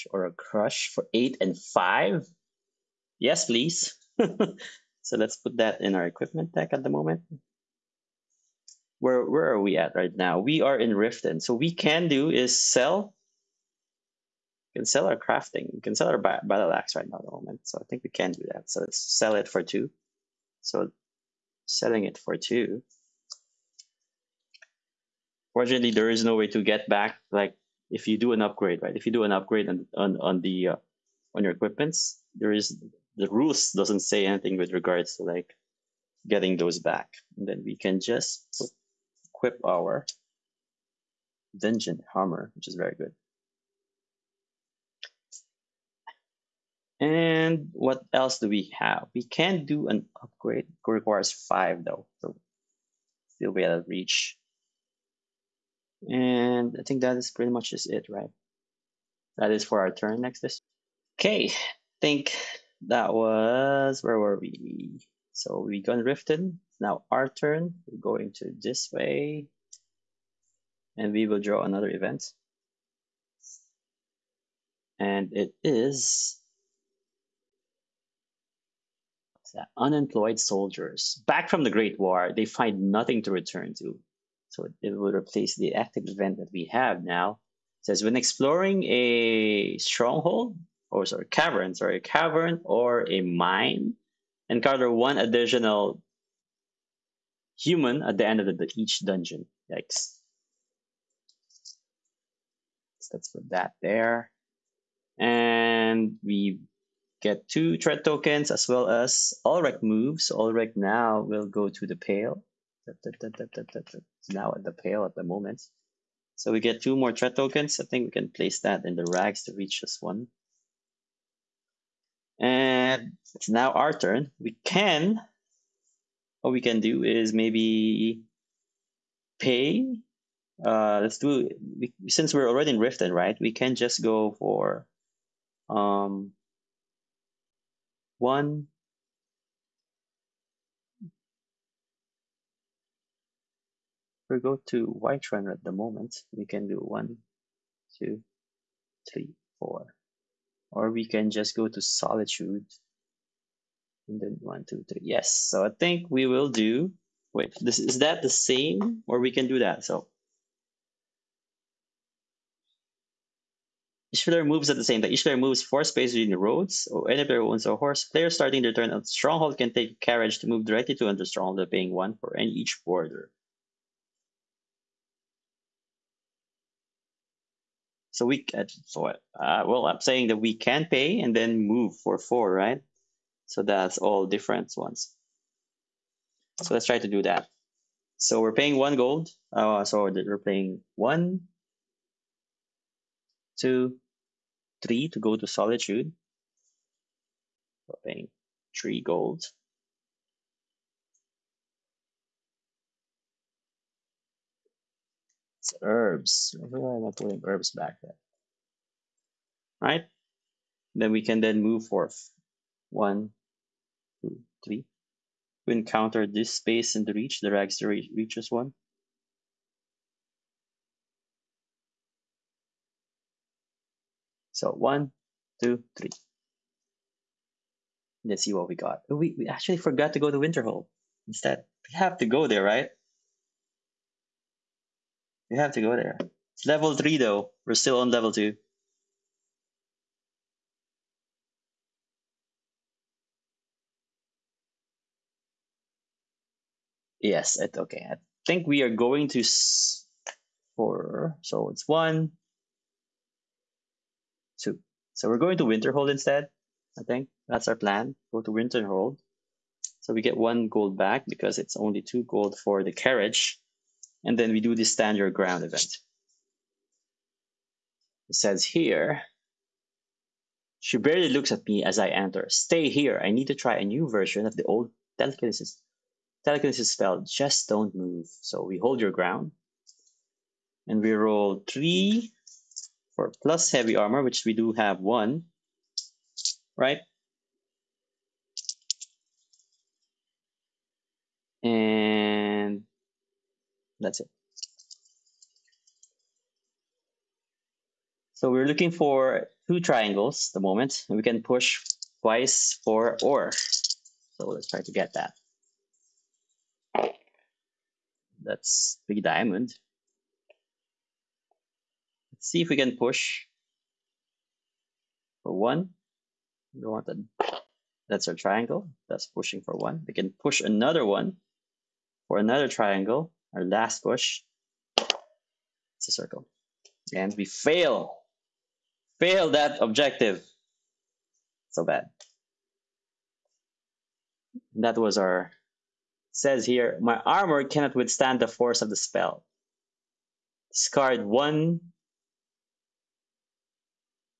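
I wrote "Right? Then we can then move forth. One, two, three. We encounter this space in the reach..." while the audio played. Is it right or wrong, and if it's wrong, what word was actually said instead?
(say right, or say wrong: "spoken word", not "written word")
right.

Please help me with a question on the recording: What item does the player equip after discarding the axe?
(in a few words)
dungeon hammer.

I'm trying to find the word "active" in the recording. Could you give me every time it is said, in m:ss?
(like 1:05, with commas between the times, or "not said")
1:25.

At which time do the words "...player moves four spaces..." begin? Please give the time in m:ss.
2:45.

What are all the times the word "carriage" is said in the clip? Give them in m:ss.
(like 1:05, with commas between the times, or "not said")
2:49, 4:22.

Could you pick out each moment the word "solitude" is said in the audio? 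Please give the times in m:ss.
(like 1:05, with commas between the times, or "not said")
2:31, 3:15.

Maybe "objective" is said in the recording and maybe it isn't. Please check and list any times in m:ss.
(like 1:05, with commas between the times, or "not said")
5:29.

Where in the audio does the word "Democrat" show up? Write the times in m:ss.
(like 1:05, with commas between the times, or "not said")
not said.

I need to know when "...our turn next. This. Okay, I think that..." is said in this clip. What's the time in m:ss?
0:59.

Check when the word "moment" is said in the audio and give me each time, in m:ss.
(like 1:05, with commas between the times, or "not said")
0:06, 0:17, 1:55, 2:25, 5:00.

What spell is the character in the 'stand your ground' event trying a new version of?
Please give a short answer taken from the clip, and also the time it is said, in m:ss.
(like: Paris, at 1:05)
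telekinesis, at 4:36.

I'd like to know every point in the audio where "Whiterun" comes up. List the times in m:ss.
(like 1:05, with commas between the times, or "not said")
2:24.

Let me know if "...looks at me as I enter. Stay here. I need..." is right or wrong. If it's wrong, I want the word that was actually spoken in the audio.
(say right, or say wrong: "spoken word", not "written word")
right.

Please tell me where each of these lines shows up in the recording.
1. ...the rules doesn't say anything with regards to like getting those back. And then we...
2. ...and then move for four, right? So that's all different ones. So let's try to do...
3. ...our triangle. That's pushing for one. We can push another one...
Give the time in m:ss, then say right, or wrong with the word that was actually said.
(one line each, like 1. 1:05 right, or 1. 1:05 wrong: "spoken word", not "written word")
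1. 0:33 right
2. 3:01 right
3. 5:18 right.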